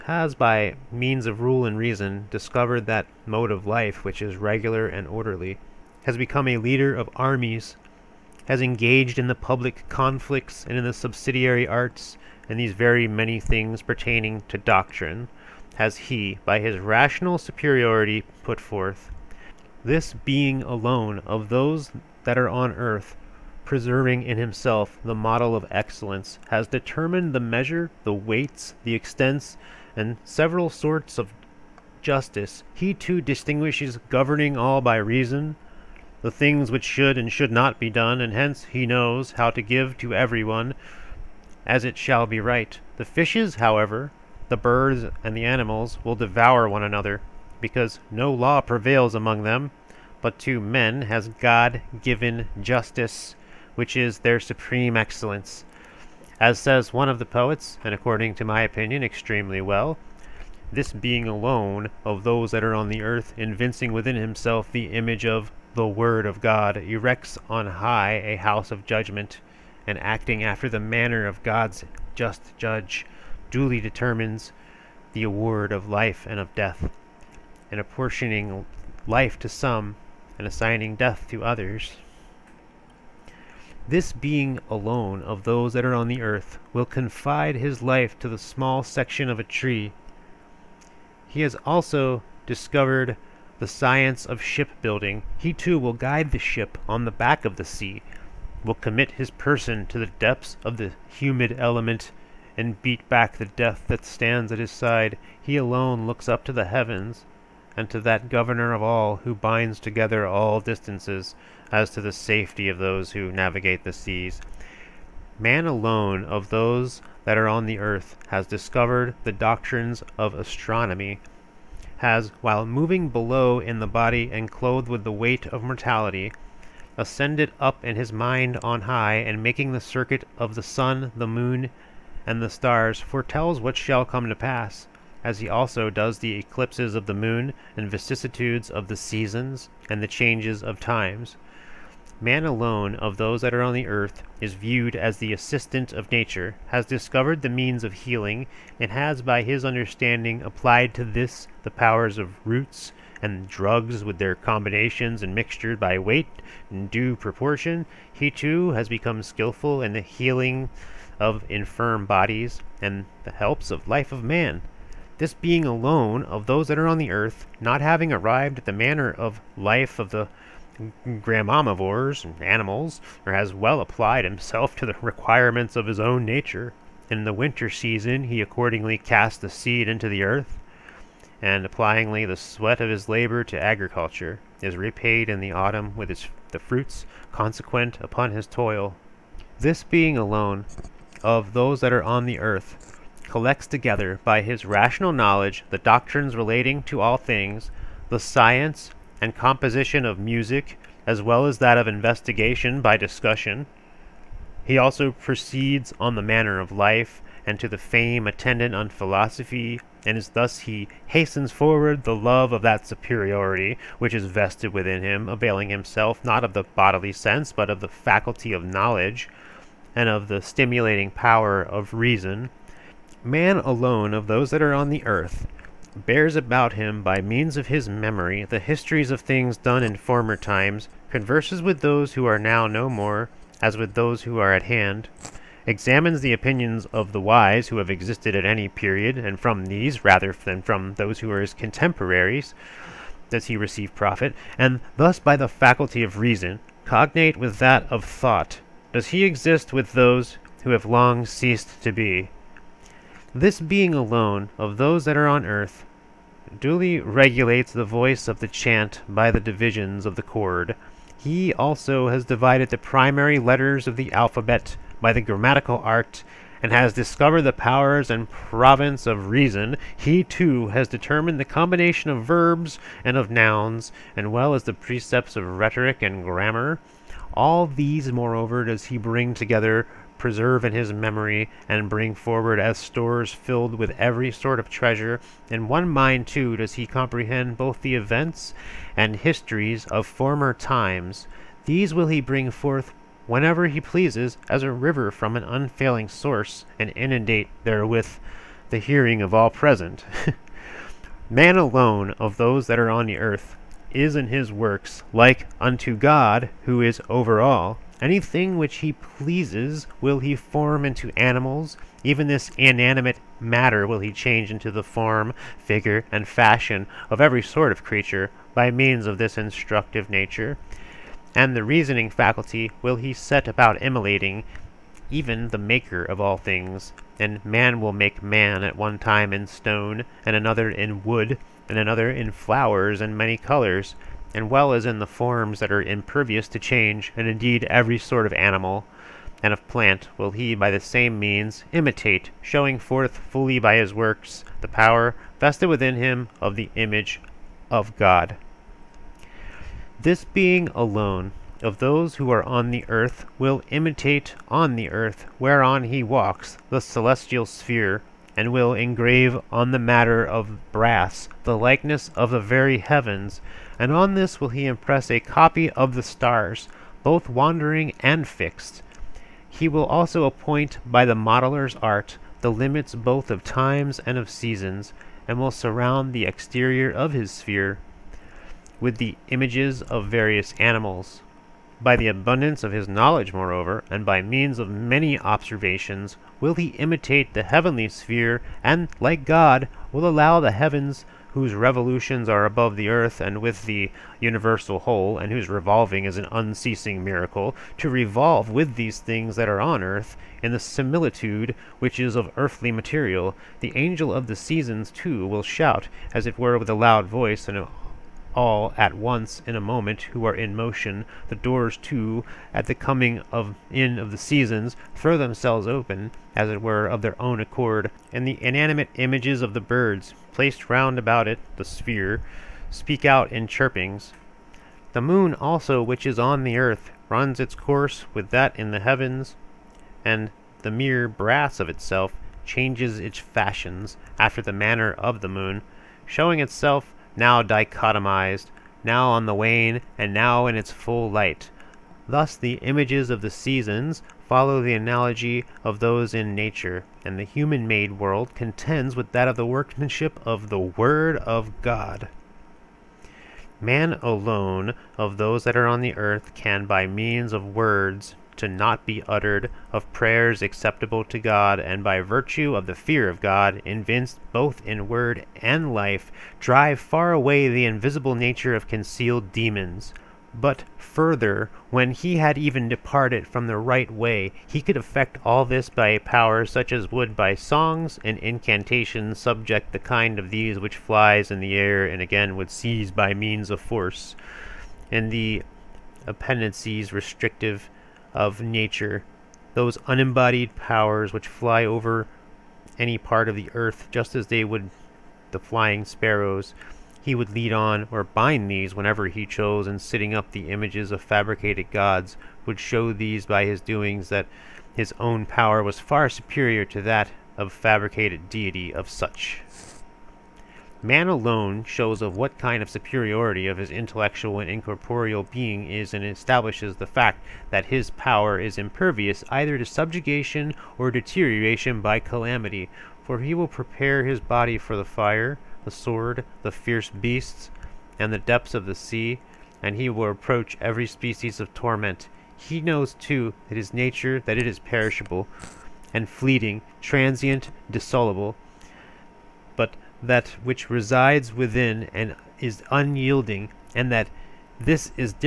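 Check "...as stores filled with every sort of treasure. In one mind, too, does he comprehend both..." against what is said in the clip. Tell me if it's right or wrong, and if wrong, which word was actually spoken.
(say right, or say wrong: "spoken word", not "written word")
right.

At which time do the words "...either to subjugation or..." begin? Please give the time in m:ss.
8:39.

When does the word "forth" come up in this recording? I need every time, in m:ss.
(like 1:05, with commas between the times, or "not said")
0:18, 4:52, 5:42.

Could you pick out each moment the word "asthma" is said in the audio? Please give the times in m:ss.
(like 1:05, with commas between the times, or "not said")
not said.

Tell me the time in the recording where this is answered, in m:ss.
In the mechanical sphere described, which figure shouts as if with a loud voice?
6:43.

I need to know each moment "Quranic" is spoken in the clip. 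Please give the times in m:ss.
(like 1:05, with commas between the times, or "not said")
not said.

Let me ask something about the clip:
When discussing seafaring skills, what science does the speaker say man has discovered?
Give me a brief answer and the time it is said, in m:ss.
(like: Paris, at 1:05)
Shipbuilding, at 1:33.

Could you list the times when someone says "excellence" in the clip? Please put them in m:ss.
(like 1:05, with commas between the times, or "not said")
0:25, 0:54.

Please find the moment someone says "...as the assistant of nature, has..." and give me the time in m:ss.
2:24.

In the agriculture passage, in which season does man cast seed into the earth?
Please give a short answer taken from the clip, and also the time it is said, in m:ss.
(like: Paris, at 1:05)
Winter, at 2:57.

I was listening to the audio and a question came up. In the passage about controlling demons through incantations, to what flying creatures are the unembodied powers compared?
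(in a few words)
Sparrows.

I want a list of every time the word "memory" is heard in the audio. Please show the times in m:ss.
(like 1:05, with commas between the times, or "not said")
3:47, 4:40.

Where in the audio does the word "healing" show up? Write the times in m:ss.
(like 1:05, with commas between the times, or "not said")
2:27, 2:40.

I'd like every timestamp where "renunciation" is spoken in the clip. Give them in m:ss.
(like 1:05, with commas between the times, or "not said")
not said.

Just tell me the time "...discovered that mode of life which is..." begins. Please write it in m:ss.
0:02.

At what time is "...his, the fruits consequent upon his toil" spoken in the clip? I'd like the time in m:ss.
3:06.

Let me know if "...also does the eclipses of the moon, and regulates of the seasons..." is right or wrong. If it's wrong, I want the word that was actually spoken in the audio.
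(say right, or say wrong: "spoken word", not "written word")
wrong: "vicissitudes", not "regulates".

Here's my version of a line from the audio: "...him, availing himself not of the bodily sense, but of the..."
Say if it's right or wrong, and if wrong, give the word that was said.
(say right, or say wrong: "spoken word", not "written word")
right.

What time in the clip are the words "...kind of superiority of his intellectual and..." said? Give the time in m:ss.
8:32.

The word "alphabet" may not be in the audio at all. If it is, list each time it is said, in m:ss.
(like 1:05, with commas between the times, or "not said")
4:24.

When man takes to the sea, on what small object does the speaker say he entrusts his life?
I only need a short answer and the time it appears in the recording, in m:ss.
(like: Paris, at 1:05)
Section of a tree, at 1:28.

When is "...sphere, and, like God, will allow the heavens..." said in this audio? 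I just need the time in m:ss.
6:27.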